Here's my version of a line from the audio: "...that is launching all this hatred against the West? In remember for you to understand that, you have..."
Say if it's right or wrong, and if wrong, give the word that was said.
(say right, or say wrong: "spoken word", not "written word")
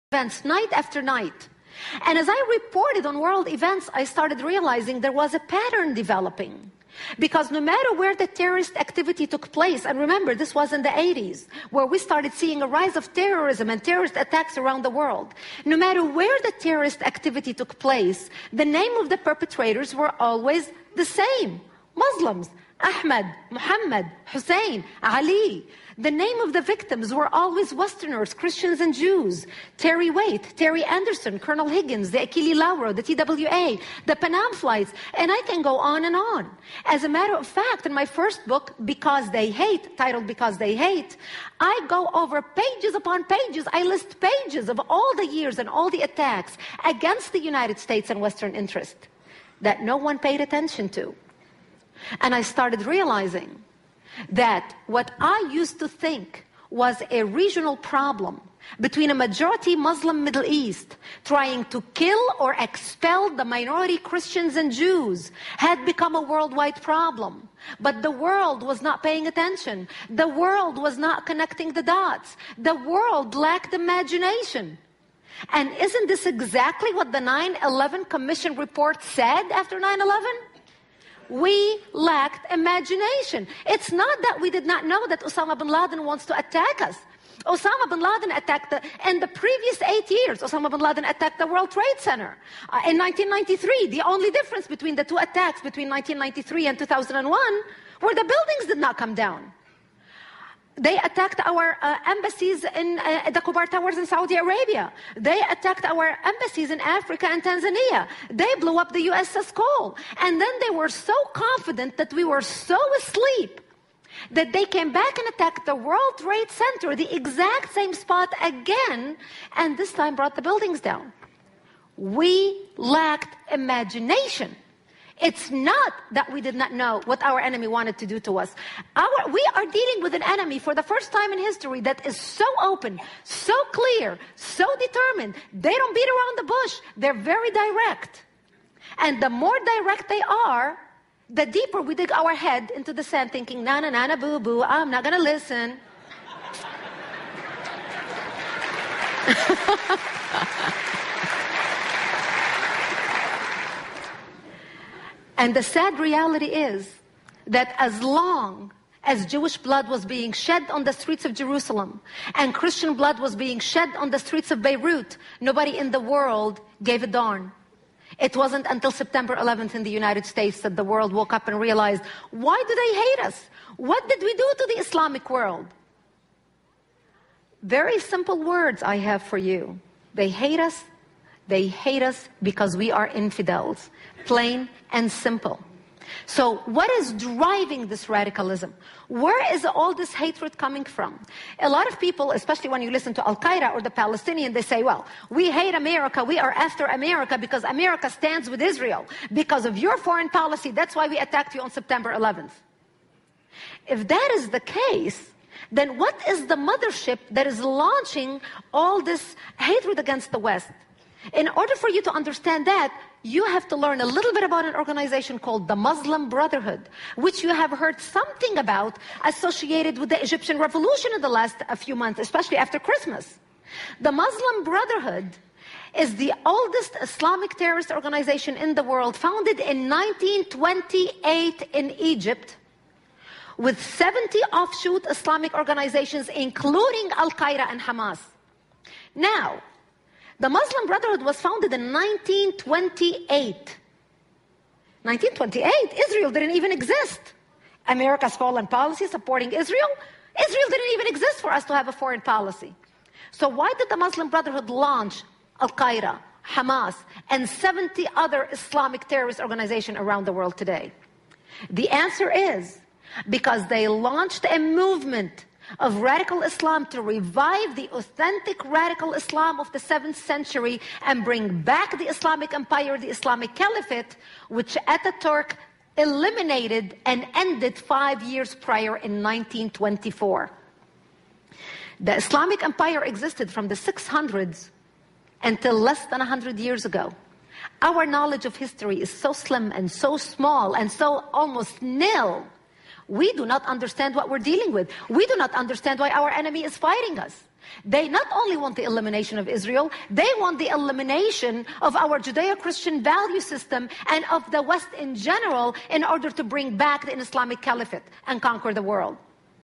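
wrong: "order", not "remember".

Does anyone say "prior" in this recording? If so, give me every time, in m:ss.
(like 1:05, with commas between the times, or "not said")
4:38.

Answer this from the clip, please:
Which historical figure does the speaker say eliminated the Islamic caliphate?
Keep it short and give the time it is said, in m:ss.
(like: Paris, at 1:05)
Ataturk, at 4:34.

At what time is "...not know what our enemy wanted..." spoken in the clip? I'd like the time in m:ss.
2:06.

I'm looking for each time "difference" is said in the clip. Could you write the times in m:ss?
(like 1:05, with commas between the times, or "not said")
1:34.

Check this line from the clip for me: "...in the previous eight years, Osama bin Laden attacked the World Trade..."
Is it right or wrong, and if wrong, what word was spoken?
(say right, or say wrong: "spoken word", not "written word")
right.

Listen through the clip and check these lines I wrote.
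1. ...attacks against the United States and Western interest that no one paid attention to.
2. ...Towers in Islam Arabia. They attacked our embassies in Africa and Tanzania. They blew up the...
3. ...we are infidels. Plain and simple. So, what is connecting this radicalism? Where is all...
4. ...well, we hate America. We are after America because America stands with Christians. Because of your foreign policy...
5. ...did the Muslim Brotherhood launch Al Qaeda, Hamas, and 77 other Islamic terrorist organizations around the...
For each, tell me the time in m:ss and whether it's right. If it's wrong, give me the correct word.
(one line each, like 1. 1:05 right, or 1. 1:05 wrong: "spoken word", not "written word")
1. 0:46 right
2. 1:43 wrong: "Saudi", not "Islam"
3. 3:02 wrong: "driving", not "connecting"
4. 3:14 wrong: "Israel", not "Christians"
5. 4:13 wrong: "70", not "77".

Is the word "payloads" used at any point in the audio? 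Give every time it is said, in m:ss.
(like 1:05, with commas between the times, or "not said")
not said.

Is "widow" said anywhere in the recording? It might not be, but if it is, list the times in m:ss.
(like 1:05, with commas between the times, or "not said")
not said.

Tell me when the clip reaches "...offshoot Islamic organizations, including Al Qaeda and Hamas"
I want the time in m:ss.
3:54.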